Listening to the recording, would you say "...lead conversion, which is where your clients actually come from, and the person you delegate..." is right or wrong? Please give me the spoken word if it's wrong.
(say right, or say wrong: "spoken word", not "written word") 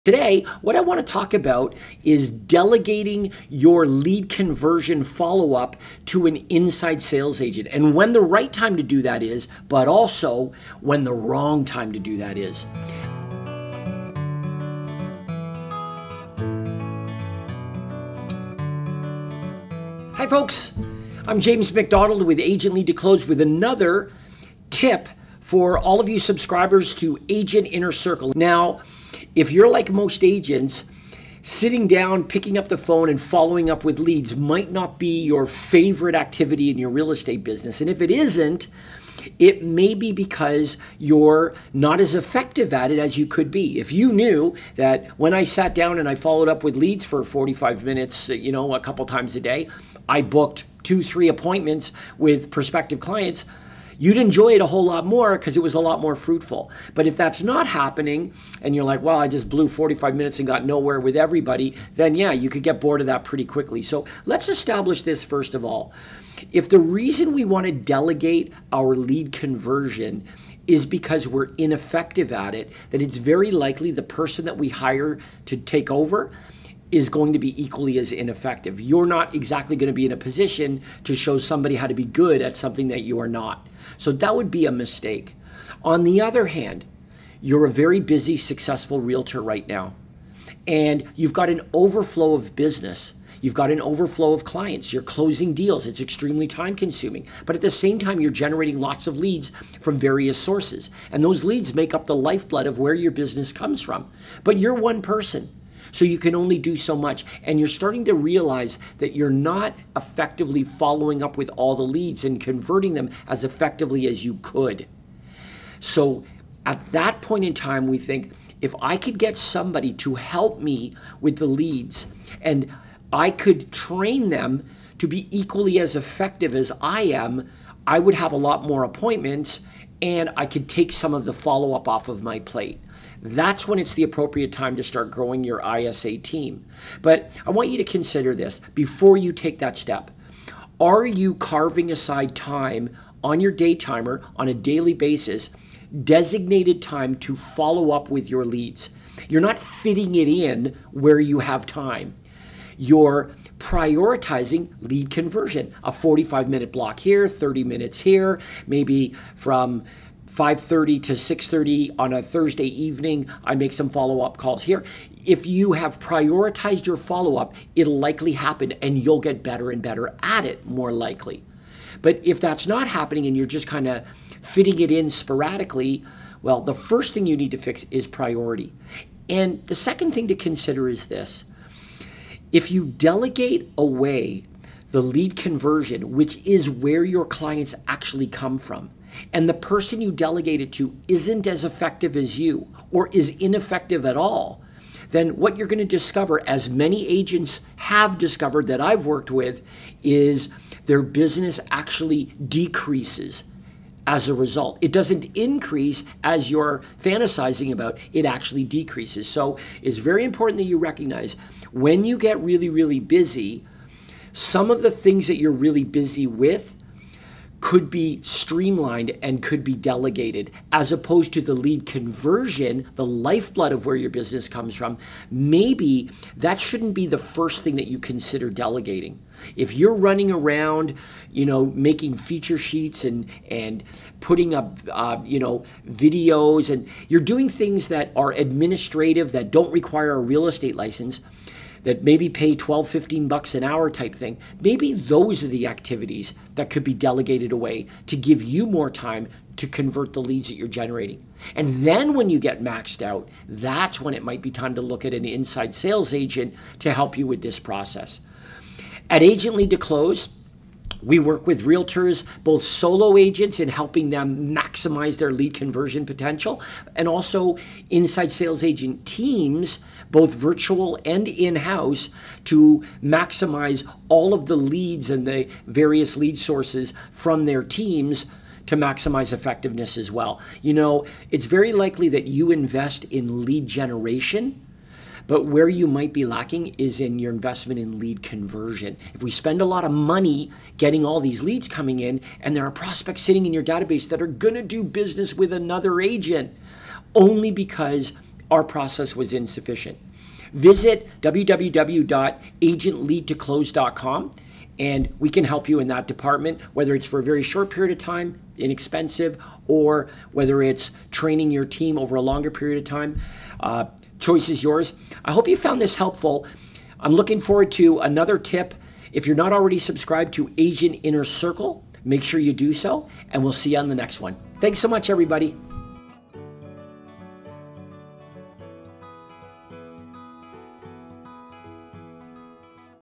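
right.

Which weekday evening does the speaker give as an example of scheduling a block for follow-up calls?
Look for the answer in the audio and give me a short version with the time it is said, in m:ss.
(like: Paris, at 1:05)
Thursday, at 2:42.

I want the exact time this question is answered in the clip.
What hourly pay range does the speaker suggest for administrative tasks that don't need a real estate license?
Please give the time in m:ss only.
4:02.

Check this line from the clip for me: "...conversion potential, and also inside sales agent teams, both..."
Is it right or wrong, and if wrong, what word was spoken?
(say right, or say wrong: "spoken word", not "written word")
right.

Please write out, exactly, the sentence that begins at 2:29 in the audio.
You're not fitting it in where you have time you're prioritizing lead conversion.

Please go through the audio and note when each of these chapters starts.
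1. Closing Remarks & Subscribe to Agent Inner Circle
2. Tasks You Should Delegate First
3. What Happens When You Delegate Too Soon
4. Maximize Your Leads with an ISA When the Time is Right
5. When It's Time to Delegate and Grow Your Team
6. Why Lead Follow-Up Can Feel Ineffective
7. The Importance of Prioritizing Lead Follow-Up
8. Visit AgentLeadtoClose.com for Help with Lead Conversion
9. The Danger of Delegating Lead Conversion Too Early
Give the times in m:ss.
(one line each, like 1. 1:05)
1. 5:24
2. 4:11
3. 3:25
4. 4:41
5. 1:45
6. 0:20
7. 2:43
8. 5:04
9. 0:57.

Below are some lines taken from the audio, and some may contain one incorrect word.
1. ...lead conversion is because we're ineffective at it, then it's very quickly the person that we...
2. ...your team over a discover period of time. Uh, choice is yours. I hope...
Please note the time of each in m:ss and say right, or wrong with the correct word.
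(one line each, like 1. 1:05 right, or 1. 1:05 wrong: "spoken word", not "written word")
1. 1:08 wrong: "likely", not "quickly"
2. 5:11 wrong: "longer", not "discover".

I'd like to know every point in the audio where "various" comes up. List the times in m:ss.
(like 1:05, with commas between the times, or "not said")
1:39, 4:35.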